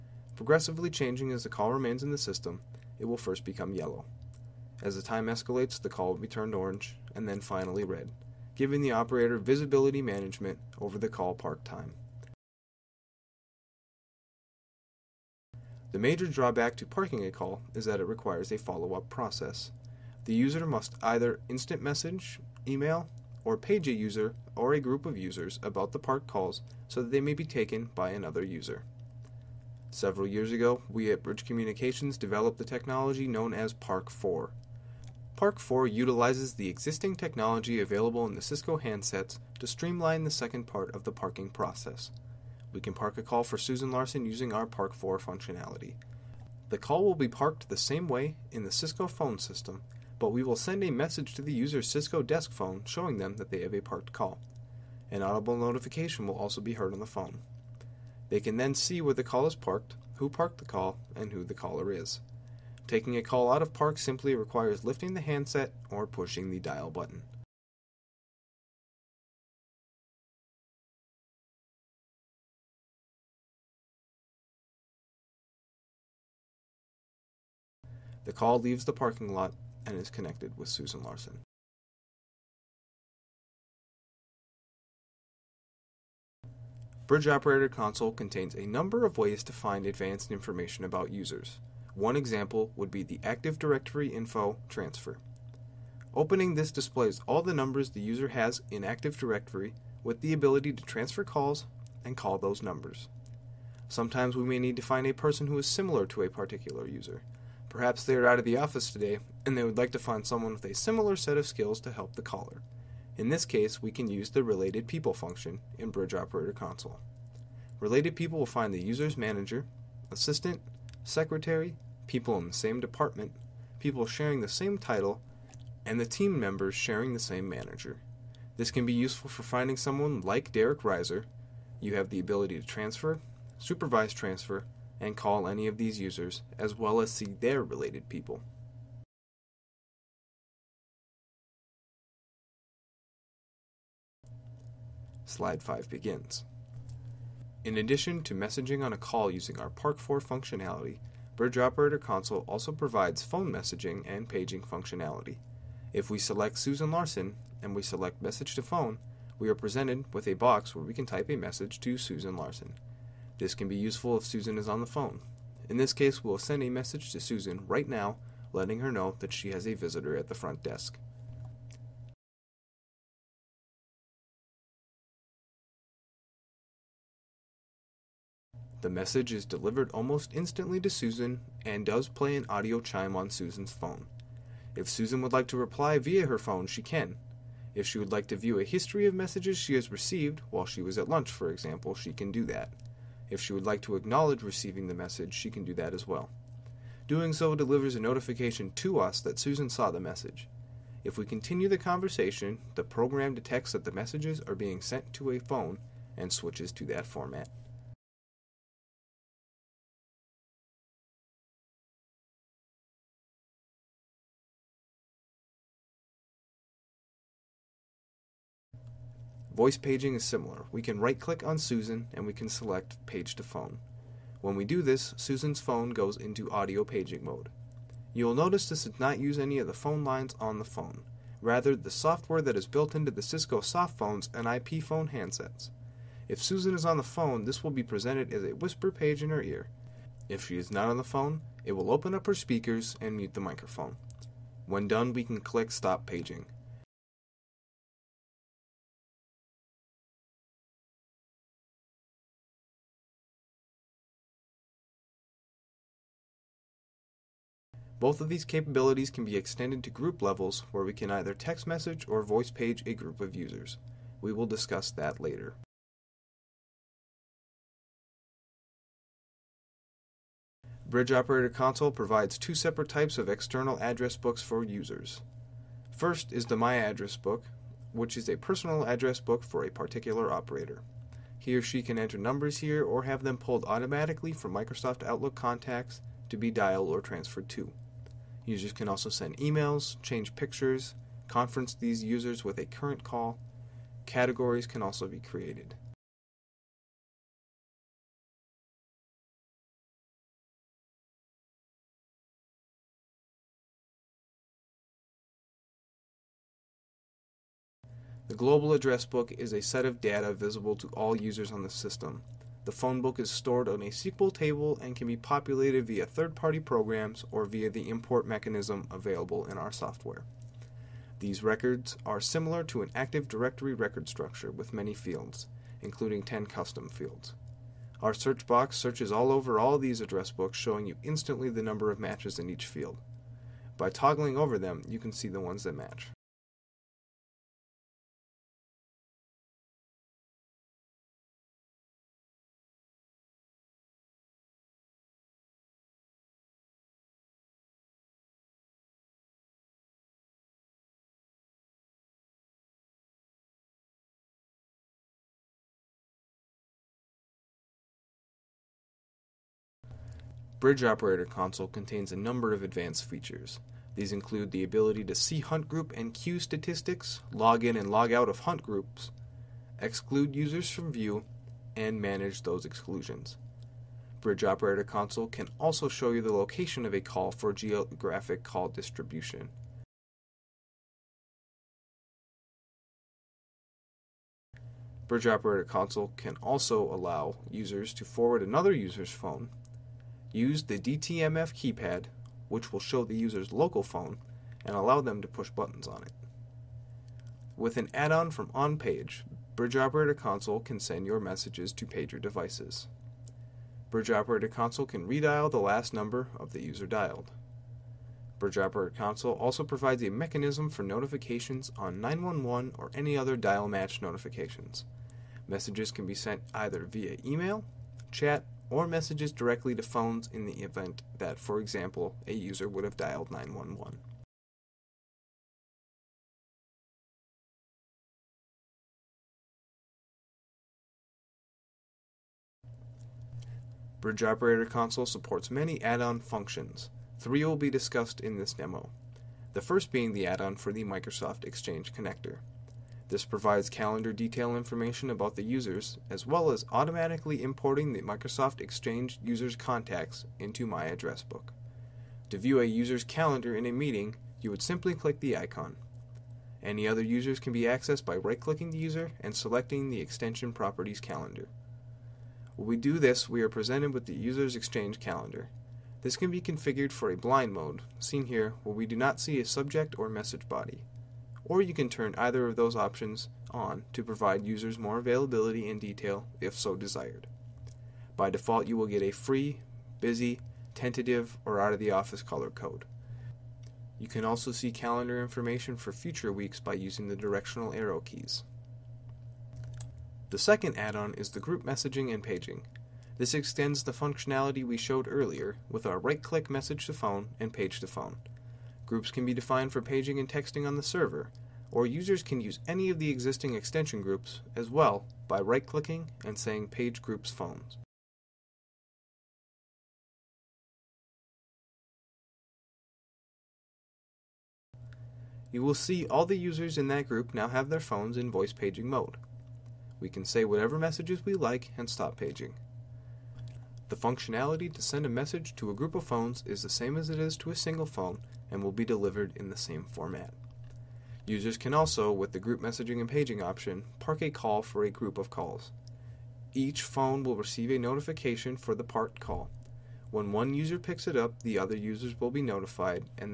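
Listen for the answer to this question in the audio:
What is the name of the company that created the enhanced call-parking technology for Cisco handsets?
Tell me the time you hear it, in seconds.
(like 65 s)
31 s.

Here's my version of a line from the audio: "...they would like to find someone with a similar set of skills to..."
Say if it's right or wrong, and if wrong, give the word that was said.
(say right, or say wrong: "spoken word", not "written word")
right.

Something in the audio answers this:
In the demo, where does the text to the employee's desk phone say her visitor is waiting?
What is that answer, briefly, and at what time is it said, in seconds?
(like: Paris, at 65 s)
the front desk, at 170 s.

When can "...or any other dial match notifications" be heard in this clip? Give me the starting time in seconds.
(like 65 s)
412 s.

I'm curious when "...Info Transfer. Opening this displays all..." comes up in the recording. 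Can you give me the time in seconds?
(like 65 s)
94 s.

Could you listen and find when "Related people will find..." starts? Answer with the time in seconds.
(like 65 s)
117 s.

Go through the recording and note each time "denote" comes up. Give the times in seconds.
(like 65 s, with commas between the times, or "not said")
not said.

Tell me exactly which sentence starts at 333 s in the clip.
By toggling over them, you can see the ones that match.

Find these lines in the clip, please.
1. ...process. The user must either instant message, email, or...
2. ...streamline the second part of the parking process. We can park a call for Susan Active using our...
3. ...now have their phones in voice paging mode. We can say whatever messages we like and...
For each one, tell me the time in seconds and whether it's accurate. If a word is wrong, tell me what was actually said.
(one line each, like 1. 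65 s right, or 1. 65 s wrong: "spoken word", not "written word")
1. 19 s right
2. 39 s wrong: "Larson", not "Active"
3. 517 s right.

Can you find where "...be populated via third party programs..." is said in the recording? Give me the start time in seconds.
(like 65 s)
315 s.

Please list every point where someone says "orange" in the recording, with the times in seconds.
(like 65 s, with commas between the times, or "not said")
6 s.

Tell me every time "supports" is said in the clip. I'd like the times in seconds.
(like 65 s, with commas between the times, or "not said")
435 s.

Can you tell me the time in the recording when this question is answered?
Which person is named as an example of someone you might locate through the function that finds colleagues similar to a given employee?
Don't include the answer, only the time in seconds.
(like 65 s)
130 s.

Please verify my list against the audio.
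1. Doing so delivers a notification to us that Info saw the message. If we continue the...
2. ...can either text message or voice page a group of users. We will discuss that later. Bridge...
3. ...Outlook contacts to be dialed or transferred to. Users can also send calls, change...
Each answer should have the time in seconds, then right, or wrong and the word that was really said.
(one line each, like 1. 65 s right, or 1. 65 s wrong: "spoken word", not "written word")
1. 197 s wrong: "Susan", not "Info"
2. 260 s right
3. 285 s wrong: "emails", not "calls".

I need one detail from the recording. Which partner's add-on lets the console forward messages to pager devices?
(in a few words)
OnPage.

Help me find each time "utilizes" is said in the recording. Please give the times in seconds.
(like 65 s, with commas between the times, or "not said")
35 s.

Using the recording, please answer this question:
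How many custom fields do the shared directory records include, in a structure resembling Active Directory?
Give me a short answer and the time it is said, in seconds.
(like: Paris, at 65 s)
10, at 326 s.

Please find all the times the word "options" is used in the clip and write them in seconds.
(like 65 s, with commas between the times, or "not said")
472 s, 533 s.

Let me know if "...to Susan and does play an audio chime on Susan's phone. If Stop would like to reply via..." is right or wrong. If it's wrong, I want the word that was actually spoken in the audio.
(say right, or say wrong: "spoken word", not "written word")
wrong: "Susan", not "Stop".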